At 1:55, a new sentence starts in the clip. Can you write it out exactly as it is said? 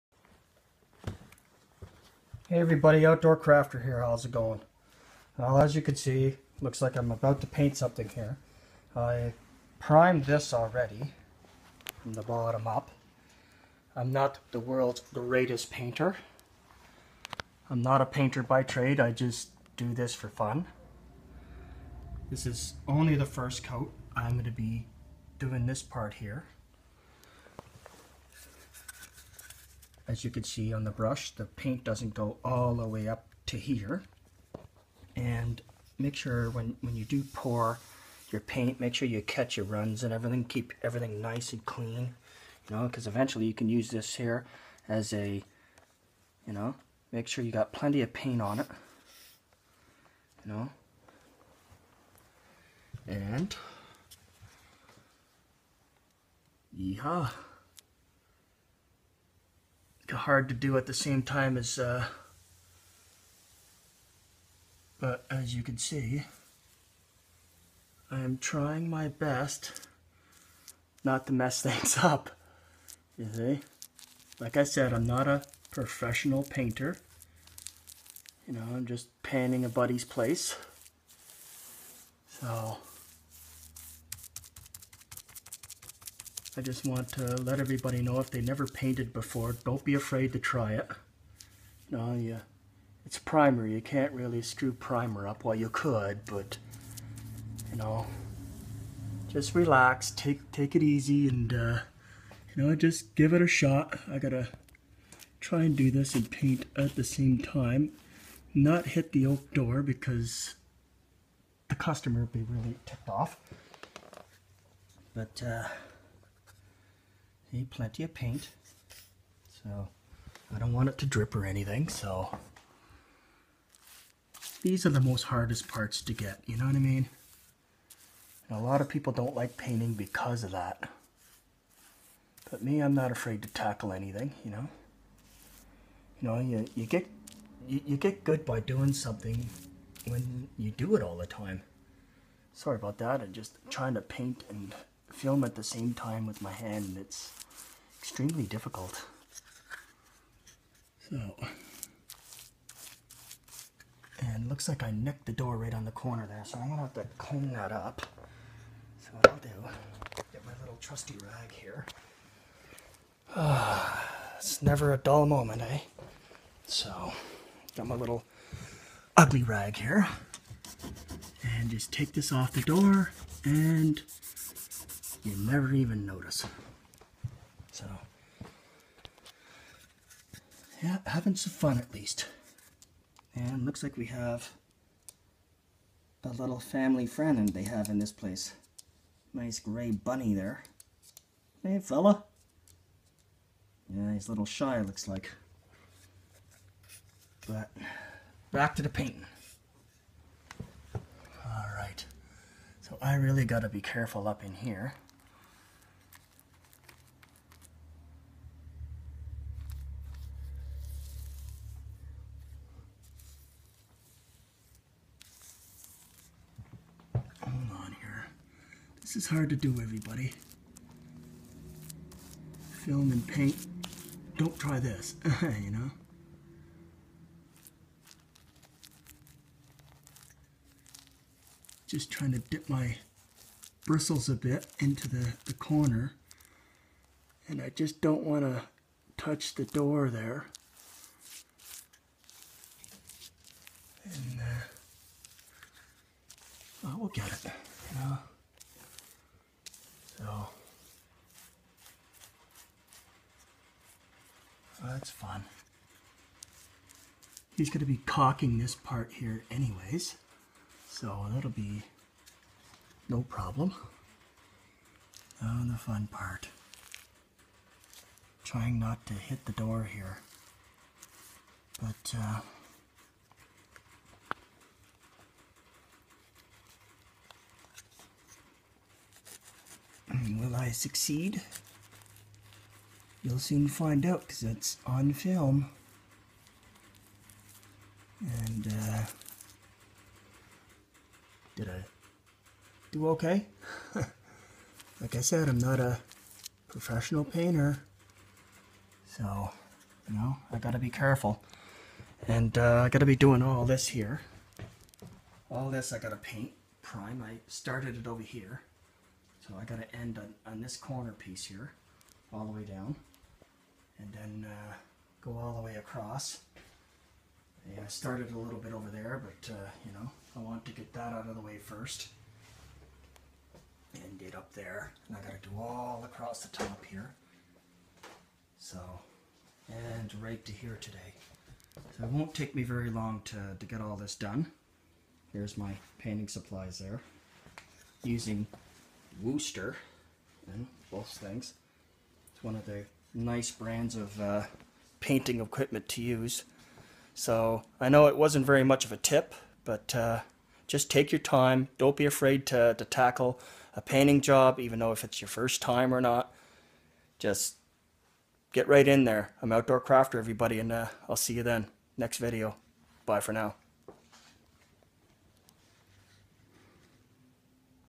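But, uh, See, plenty of paint.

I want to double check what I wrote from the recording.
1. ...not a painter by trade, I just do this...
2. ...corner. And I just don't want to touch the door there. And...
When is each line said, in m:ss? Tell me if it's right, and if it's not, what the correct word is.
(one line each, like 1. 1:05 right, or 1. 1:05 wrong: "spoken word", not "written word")
1. 0:17 right
2. 3:55 right.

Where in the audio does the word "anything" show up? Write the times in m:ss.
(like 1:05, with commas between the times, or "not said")
2:01, 2:13.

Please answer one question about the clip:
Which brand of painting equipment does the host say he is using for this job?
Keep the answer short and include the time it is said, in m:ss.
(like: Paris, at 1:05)
Wooster, at 5:39.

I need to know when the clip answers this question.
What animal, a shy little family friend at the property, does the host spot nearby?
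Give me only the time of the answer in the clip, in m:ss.
3:09.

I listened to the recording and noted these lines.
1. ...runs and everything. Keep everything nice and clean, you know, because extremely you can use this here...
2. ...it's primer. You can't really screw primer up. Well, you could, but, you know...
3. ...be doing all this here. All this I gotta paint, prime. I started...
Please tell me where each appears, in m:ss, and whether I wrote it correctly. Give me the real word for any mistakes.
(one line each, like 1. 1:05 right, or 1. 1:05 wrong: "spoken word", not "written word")
1. 0:39 wrong: "eventually", not "extremely"
2. 1:33 right
3. 5:03 right.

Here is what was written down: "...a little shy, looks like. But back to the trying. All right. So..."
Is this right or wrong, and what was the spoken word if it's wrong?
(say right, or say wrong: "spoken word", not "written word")
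wrong: "painting", not "trying".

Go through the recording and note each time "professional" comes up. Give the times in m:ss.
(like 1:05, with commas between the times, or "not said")
1:15, 4:56.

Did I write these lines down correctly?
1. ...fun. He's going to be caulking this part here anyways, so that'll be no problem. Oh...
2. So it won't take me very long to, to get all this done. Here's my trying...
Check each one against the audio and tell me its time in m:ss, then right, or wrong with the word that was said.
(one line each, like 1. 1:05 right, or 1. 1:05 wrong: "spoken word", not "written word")
1. 4:15 right
2. 5:31 wrong: "painting", not "trying".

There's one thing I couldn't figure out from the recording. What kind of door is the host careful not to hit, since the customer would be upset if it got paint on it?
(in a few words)
oak.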